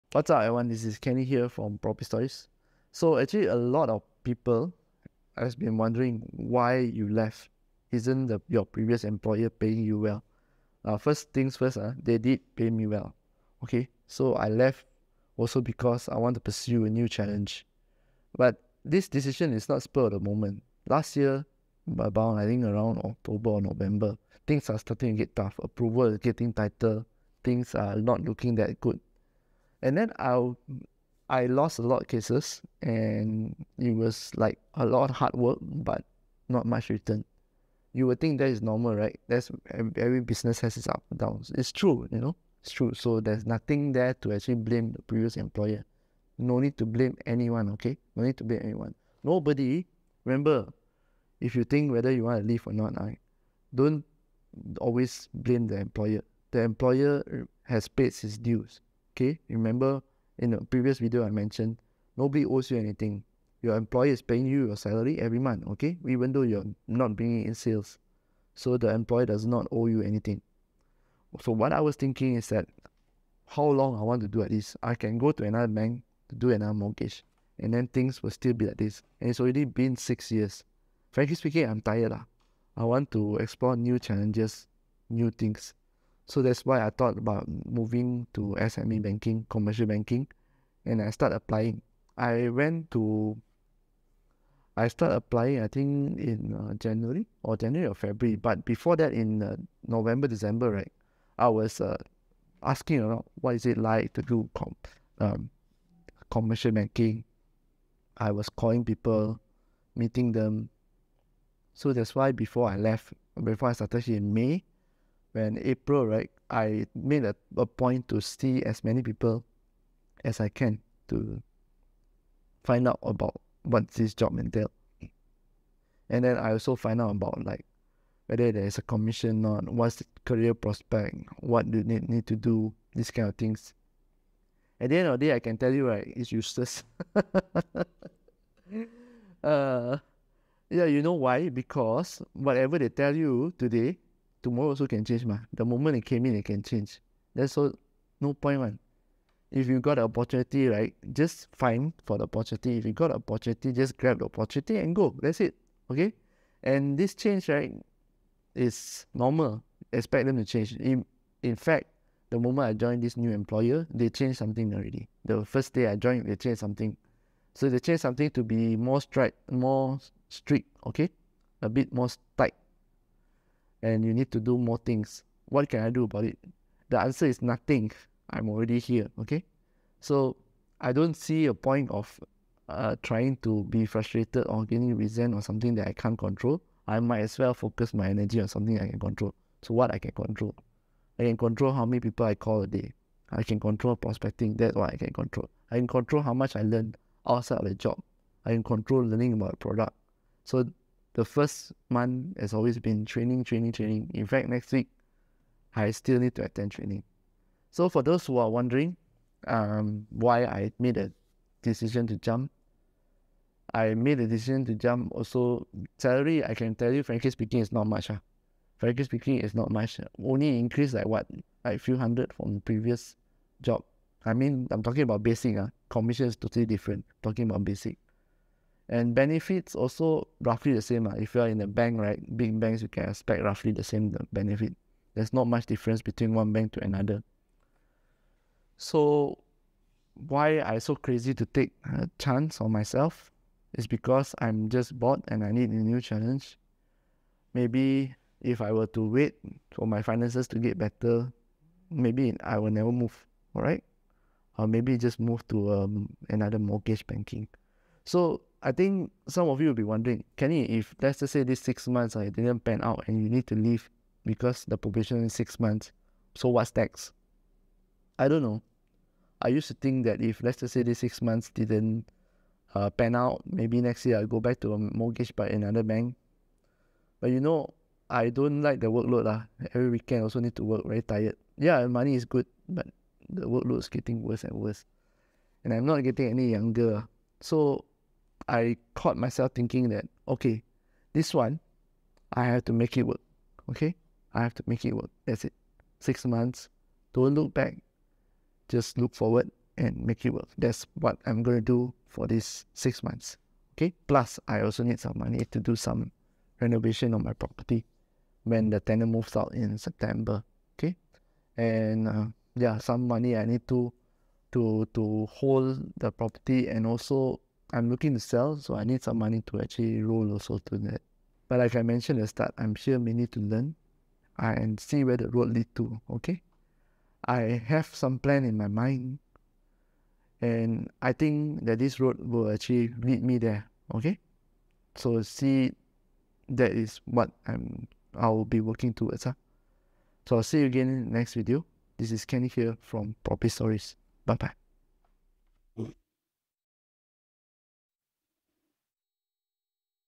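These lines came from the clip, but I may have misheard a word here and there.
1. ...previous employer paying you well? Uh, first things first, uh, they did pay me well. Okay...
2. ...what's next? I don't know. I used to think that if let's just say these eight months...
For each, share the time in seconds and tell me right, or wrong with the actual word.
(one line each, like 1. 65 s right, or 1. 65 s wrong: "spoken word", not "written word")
1. 8 s right
2. 266 s wrong: "six", not "eight".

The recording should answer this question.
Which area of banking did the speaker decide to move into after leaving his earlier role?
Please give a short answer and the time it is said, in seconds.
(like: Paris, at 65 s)
SME banking, at 88 s.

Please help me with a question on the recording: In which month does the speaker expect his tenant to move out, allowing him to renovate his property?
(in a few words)
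September.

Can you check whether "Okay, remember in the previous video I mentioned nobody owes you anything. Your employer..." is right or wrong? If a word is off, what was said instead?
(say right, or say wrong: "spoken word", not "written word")
right.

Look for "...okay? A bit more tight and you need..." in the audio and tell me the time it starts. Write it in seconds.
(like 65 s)
170 s.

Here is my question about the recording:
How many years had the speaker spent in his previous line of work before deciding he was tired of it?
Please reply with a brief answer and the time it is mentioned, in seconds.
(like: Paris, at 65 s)
6, at 79 s.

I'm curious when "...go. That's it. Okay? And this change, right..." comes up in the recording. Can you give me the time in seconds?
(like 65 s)
154 s.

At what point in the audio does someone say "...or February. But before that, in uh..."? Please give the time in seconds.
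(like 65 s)
97 s.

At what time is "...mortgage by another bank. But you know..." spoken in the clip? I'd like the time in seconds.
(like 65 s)
274 s.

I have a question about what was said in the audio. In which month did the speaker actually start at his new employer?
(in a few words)
May.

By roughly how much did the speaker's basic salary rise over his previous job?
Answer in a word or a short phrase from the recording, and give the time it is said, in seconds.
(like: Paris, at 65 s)
few hundred, at 221 s.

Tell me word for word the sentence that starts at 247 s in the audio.
Maybe if I were to wait for my finances to get better, maybe I will never move, all right?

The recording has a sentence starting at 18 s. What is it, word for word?
But this decision is not spur of the moment.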